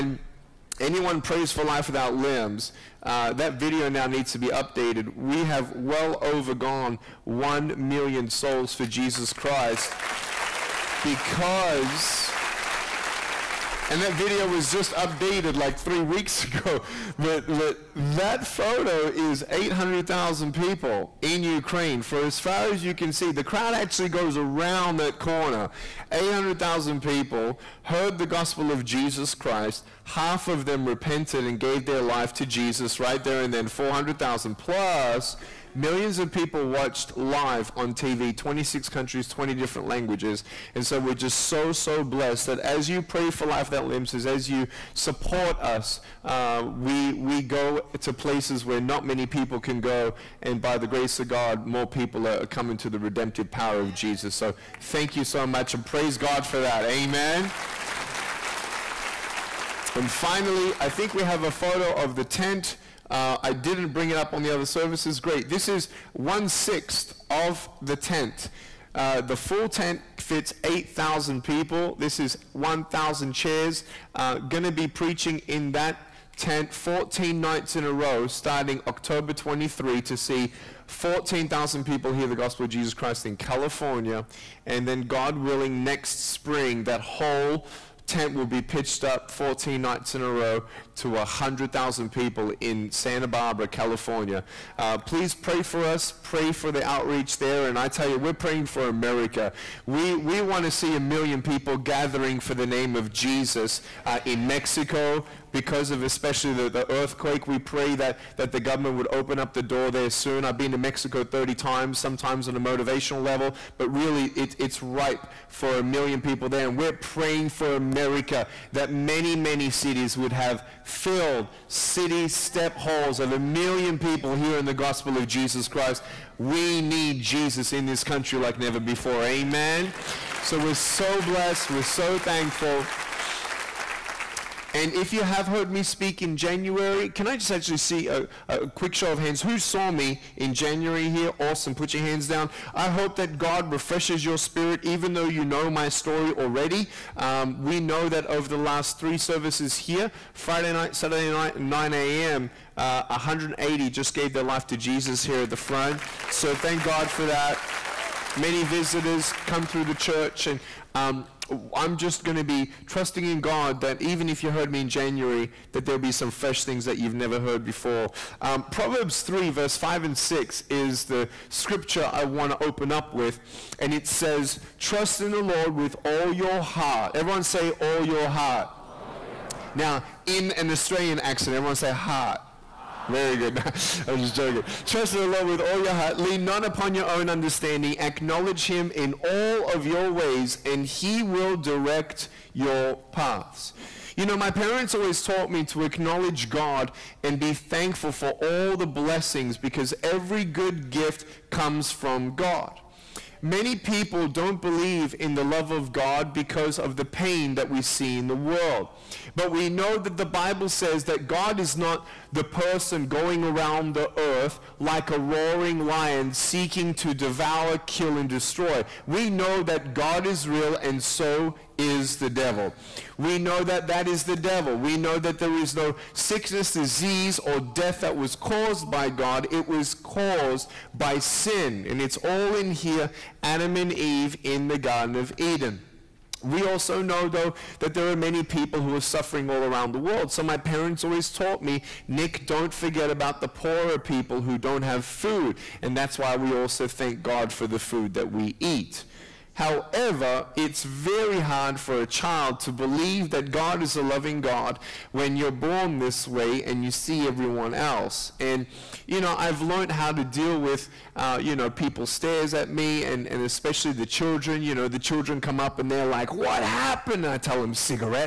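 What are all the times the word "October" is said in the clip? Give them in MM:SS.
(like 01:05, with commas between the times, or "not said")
01:18.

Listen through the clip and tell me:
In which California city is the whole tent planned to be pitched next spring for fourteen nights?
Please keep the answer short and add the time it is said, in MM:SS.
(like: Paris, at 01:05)
Santa Barbara, at 01:32.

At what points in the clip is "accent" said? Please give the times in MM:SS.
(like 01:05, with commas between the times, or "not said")
03:01.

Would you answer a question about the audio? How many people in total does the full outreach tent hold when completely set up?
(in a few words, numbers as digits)
8,000.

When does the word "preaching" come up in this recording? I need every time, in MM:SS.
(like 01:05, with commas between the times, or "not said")
01:14.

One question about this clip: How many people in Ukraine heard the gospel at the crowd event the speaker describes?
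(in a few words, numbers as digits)
800,000.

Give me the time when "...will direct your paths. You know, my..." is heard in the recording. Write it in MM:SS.
03:11.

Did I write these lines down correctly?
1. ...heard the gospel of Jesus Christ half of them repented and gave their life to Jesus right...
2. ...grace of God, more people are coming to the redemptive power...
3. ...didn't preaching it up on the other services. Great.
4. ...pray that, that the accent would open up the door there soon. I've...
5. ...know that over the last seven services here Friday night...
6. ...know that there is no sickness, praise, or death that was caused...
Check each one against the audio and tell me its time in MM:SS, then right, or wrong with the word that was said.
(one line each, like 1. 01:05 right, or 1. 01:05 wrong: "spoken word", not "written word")
1. 00:27 right
2. 00:50 right
3. 01:03 wrong: "bring", not "preaching"
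4. 01:47 wrong: "government", not "accent"
5. 02:27 wrong: "three", not "seven"
6. 03:44 wrong: "disease", not "praise".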